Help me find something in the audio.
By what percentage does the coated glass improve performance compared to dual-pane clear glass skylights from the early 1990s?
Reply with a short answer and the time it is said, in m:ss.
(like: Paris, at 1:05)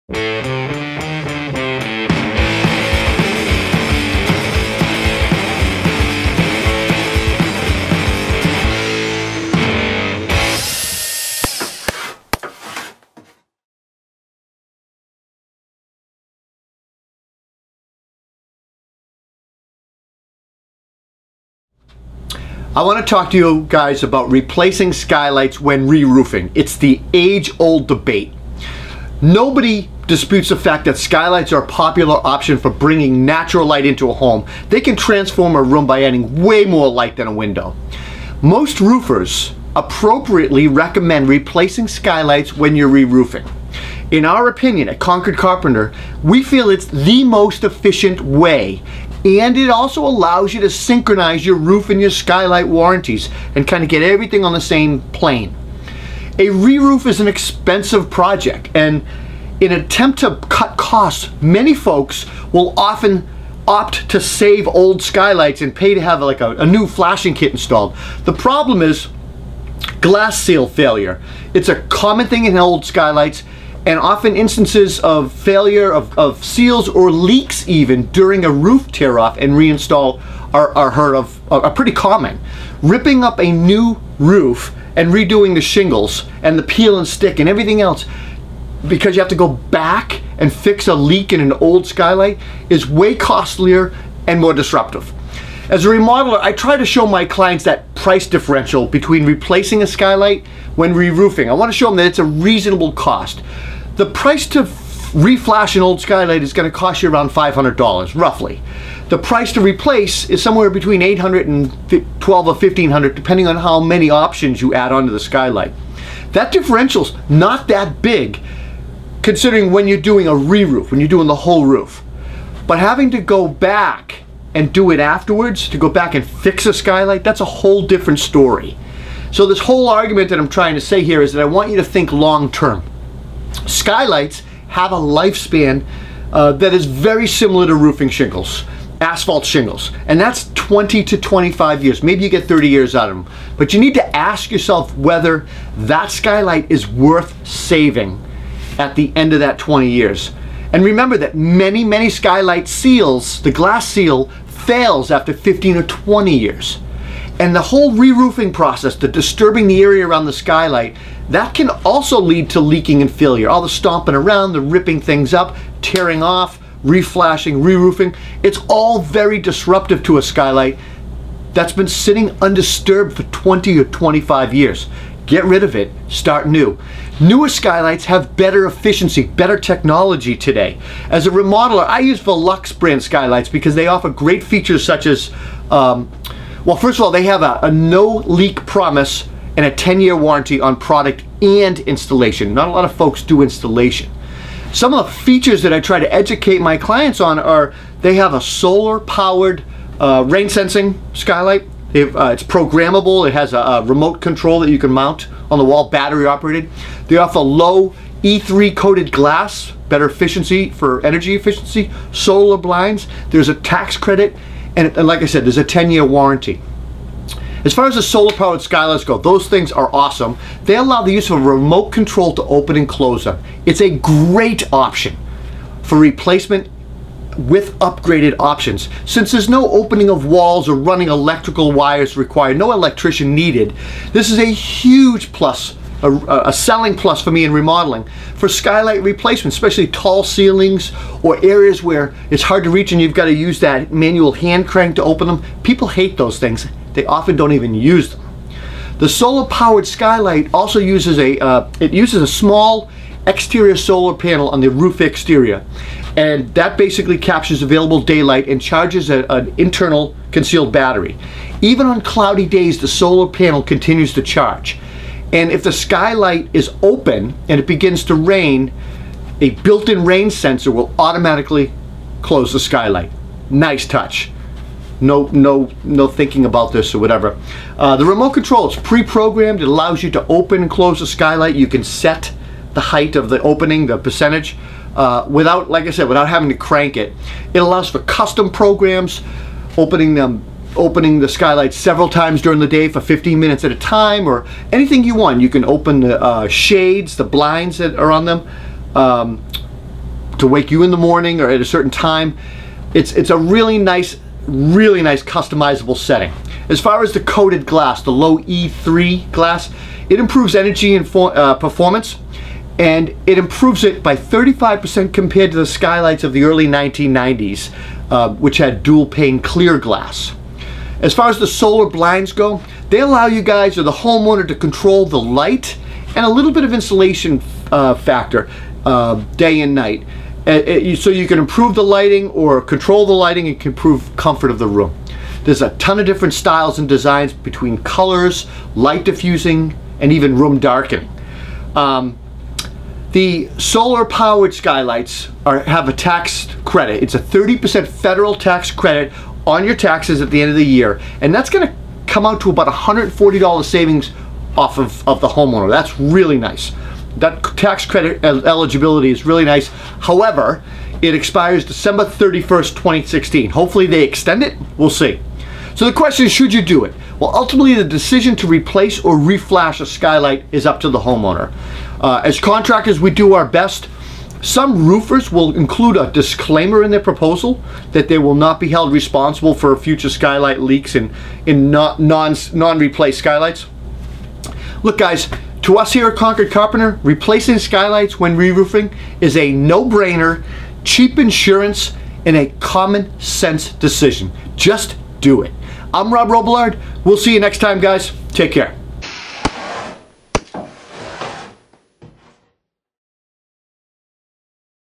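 35%, at 5:14.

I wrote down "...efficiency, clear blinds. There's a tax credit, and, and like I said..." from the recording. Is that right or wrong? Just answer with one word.
wrong.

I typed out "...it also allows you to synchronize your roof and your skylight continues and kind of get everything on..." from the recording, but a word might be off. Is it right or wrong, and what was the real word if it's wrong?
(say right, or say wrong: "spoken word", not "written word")
wrong: "warranties", not "continues".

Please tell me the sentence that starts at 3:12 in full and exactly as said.
Not a lot of folks do installation.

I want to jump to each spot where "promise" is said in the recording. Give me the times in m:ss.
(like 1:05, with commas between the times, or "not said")
3:08.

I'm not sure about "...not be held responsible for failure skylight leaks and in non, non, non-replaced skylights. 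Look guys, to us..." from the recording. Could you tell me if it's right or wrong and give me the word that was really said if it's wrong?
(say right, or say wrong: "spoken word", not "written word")
wrong: "future", not "failure".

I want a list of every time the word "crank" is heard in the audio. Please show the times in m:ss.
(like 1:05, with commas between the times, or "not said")
4:04, 4:46.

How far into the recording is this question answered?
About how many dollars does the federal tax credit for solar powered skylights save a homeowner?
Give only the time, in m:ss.
5:52.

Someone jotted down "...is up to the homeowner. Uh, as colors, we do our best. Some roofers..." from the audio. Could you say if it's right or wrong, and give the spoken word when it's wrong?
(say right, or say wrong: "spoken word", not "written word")
wrong: "contractors", not "colors".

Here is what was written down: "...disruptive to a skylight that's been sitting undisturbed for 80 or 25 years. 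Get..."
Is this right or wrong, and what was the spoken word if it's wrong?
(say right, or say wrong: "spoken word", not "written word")
wrong: "20", not "80".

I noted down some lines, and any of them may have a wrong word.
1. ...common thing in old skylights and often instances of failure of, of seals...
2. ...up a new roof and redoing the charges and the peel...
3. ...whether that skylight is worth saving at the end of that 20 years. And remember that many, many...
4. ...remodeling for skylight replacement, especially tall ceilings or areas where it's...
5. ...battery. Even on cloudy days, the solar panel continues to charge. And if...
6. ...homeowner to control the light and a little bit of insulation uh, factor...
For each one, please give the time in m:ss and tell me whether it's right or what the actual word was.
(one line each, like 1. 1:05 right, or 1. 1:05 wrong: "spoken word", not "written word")
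1. 1:11 right
2. 1:23 wrong: "shingles", not "charges"
3. 2:24 right
4. 3:57 right
5. 4:20 right
6. 5:23 right.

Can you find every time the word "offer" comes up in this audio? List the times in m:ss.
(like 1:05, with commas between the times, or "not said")
3:03, 3:27.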